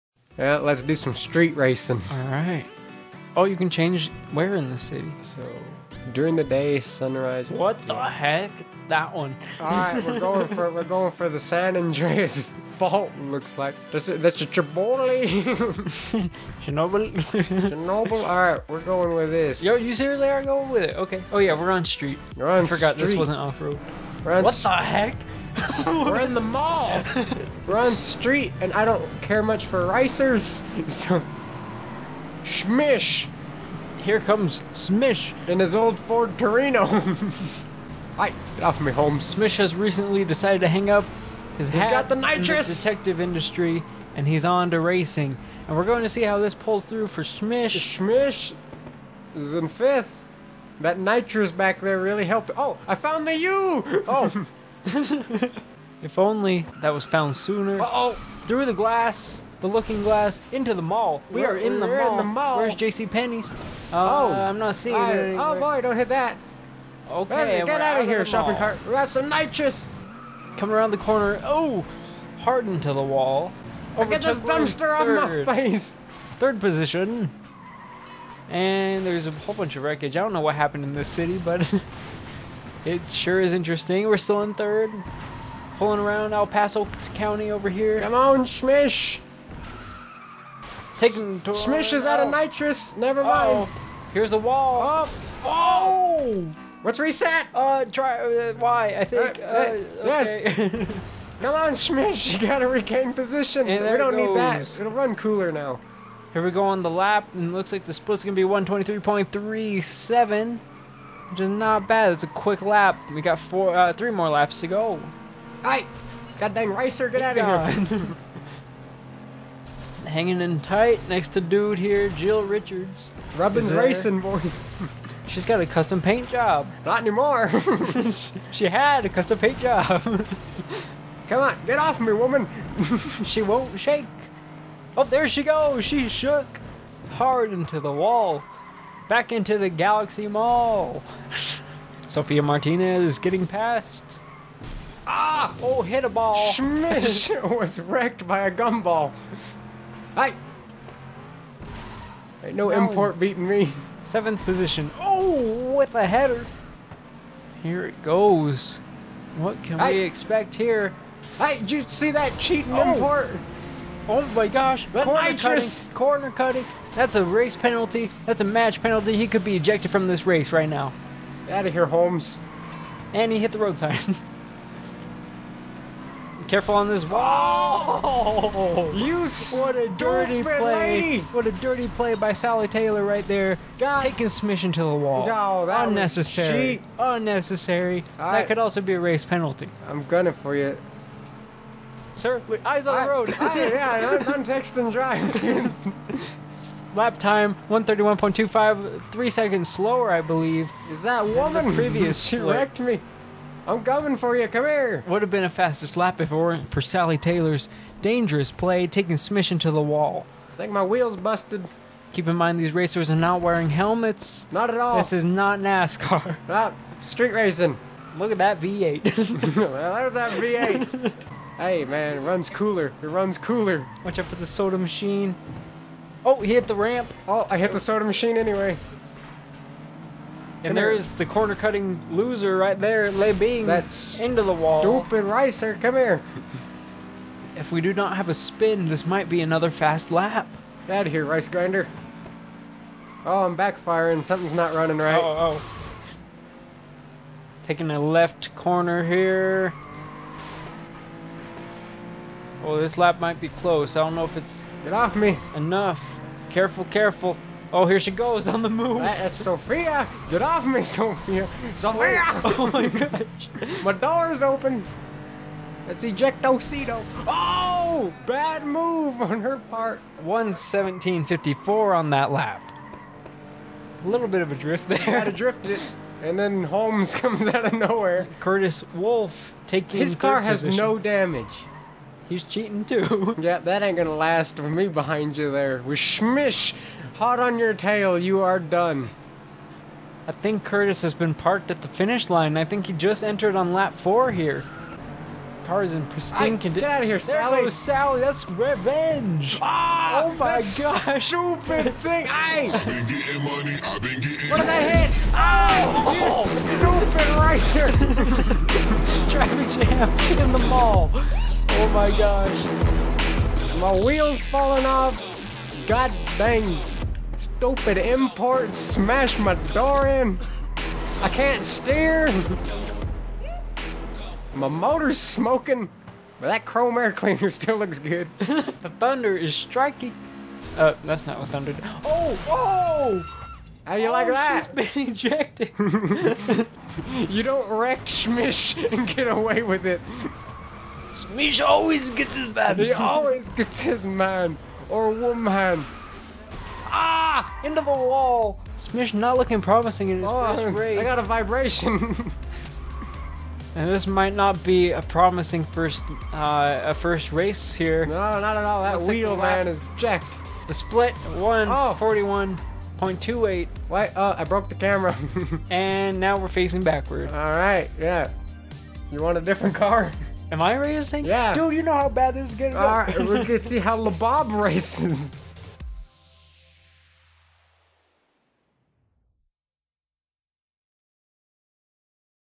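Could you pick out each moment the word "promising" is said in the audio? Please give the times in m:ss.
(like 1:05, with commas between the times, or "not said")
5:49, 5:55.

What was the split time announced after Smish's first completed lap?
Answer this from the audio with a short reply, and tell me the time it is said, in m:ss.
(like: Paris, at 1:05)
123.37, at 1:48.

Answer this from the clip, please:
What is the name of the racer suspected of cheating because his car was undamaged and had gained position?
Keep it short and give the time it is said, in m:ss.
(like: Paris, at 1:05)
Curtis Wolf, at 4:38.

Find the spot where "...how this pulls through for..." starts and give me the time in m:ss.
0:46.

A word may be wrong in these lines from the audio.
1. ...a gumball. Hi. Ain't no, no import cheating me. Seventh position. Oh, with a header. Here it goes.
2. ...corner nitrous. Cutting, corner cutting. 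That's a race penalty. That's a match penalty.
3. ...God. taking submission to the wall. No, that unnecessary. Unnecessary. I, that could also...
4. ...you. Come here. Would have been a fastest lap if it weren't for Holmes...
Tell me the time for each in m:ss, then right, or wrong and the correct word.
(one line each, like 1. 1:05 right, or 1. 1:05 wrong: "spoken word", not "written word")
1. 2:28 wrong: "beating", not "cheating"
2. 2:45 right
3. 3:03 right
4. 3:24 wrong: "Sally", not "Holmes".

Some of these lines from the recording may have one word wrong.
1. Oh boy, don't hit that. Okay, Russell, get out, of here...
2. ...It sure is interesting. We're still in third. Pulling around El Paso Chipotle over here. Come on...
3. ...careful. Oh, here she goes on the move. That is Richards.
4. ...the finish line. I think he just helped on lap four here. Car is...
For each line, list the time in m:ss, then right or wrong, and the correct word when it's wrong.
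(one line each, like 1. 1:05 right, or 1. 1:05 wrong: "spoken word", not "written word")
1. 1:05 right
2. 1:22 wrong: "County", not "Chipotle"
3. 4:16 wrong: "Sofia", not "Richards"
4. 4:51 wrong: "entered", not "helped".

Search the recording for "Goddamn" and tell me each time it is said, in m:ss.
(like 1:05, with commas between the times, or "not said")
1:56.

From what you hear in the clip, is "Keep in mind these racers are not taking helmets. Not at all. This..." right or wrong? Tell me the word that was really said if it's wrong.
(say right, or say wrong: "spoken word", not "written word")
wrong: "wearing", not "taking".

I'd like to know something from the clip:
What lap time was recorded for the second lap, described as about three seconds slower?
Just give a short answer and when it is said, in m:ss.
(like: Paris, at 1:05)
131.25, at 3:17.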